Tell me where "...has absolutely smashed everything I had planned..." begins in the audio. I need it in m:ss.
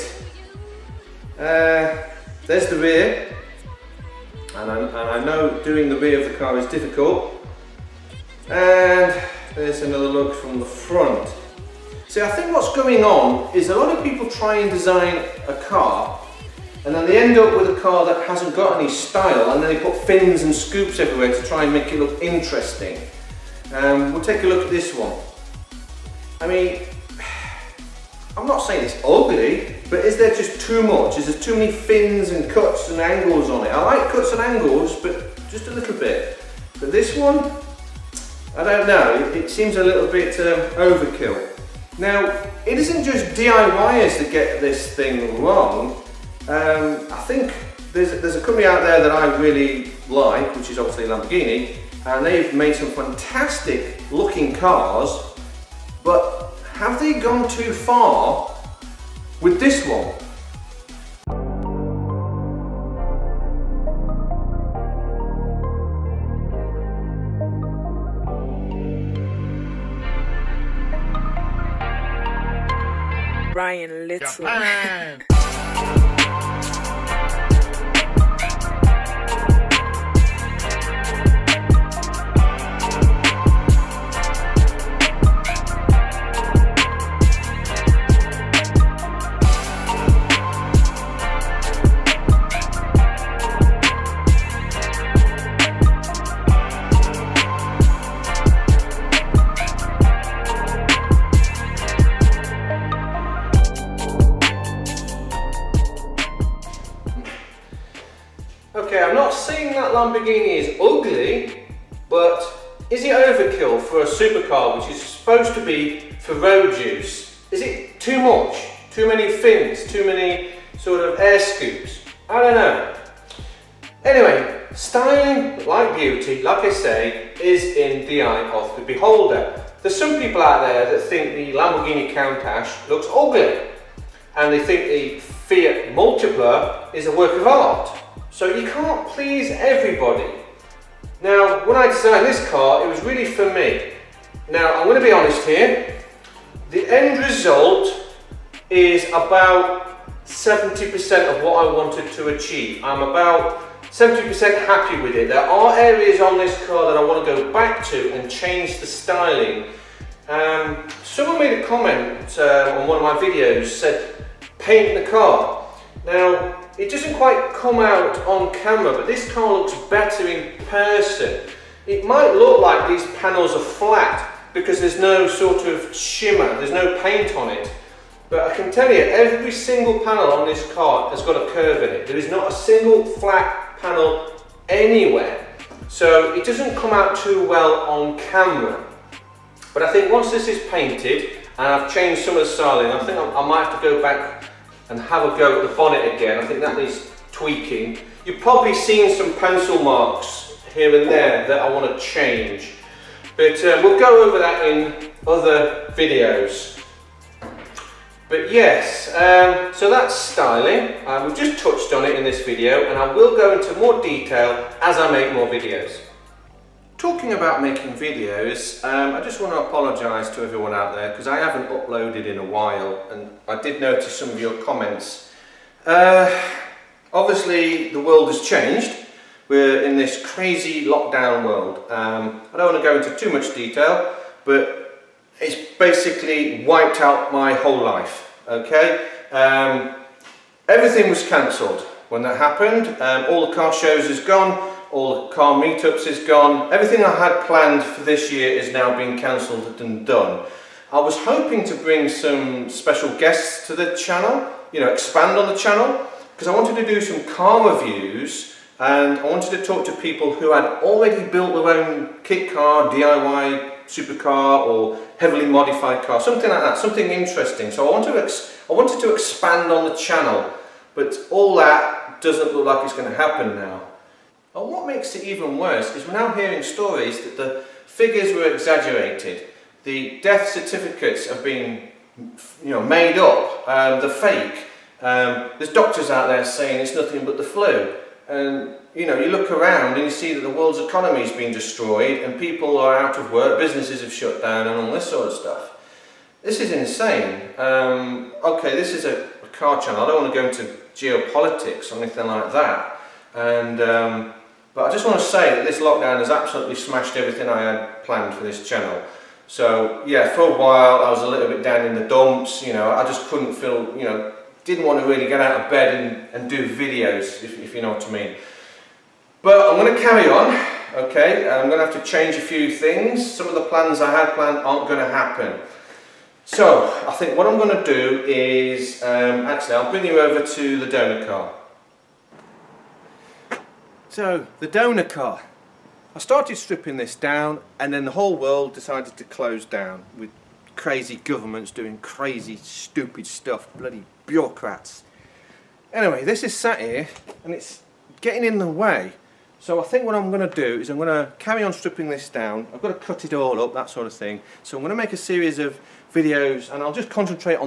5:06.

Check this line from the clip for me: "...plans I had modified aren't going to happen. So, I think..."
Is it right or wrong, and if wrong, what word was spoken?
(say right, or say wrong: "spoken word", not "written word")
wrong: "planned", not "modified".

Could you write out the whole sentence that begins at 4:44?
Um, there's doctors out there saying it's nothing but the flu.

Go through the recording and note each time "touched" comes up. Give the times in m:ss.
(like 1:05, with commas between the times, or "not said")
3:31.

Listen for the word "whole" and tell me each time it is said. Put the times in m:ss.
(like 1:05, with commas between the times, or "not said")
3:57, 5:38.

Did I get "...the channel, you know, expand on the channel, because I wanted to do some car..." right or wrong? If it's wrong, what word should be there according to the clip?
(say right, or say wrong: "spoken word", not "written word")
right.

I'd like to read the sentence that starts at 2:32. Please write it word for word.
I'm about 70% happy with it.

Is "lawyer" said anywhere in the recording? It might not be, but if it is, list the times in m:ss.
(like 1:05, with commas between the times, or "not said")
not said.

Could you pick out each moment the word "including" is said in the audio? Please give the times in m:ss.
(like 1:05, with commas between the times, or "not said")
not said.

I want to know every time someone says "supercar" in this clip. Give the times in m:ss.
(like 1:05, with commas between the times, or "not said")
1:54, 4:23.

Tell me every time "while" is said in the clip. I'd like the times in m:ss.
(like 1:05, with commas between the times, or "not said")
3:42, 5:10.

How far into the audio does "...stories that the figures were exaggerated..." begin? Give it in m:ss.
4:36.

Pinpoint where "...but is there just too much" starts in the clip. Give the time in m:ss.
0:29.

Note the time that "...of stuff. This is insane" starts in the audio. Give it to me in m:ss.
4:55.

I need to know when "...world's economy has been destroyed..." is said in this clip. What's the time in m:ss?
4:50.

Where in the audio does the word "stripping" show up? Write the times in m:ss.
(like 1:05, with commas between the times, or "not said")
5:36, 5:51.